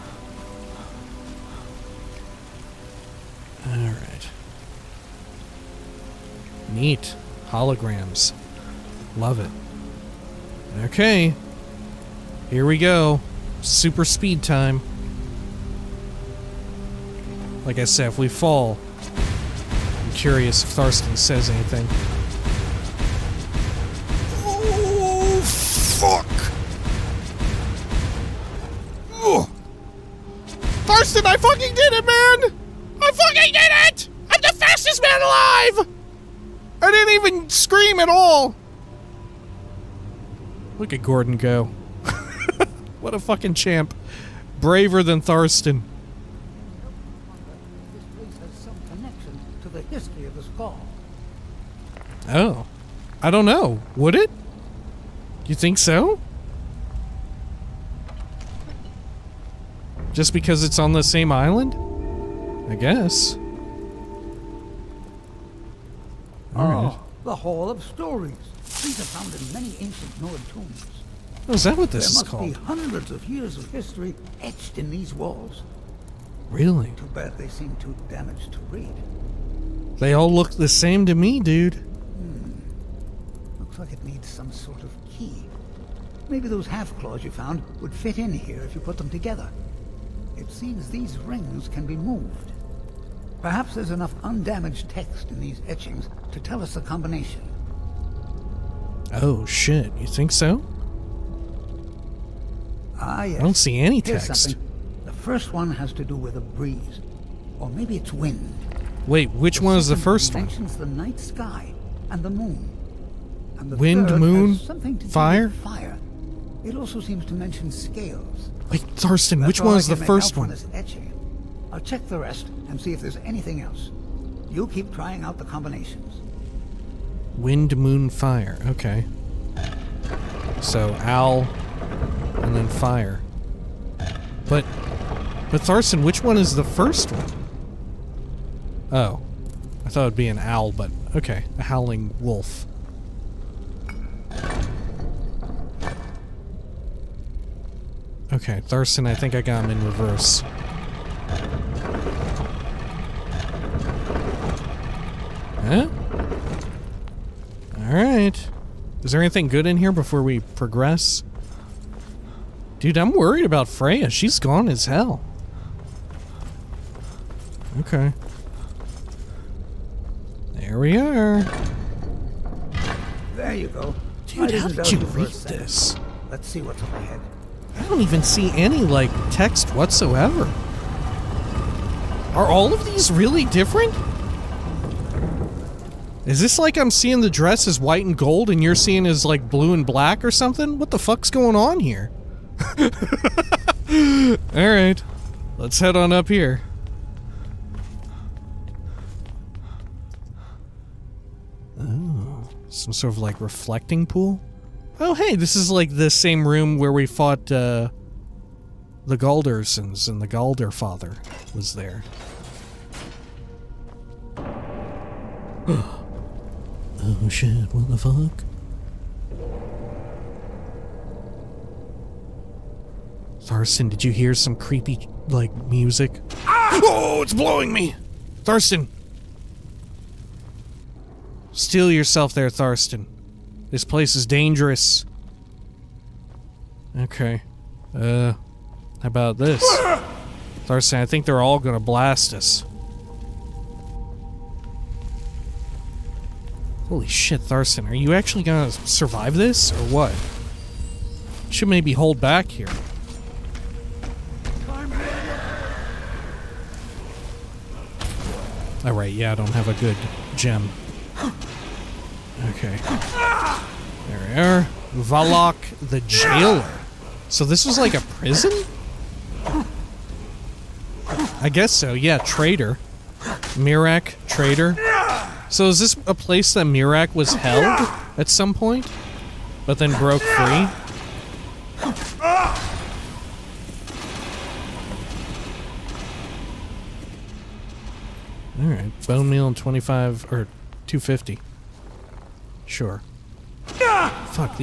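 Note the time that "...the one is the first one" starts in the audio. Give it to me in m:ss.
1:49.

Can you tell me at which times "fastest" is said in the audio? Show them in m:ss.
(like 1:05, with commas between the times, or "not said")
0:34.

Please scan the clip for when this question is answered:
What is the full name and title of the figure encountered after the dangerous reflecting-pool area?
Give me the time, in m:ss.
4:25.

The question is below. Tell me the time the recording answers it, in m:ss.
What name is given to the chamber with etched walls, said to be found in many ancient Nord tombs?
1:07.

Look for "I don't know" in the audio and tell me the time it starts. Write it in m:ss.
0:53.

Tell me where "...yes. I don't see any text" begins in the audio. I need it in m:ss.
1:43.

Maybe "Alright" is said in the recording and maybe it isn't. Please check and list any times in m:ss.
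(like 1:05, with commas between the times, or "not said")
0:03, 2:37, 3:14, 4:18, 4:48.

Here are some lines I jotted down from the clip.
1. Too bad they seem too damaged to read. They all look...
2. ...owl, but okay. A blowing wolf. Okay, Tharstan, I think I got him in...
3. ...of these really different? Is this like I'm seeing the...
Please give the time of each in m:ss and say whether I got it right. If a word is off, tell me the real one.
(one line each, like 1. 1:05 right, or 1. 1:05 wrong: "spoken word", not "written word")
1. 1:16 right
2. 2:20 wrong: "howling", not "blowing"
3. 3:02 right.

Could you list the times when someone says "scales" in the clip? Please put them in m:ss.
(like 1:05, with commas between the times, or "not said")
1:57.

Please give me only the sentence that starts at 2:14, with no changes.
But, but Tharstan, which one is the first one?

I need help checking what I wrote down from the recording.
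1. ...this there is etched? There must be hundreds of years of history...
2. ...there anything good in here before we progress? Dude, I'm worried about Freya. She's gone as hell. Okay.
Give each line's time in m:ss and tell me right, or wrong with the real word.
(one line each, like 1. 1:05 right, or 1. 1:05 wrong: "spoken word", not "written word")
1. 1:11 wrong: "called", not "etched"
2. 2:39 right.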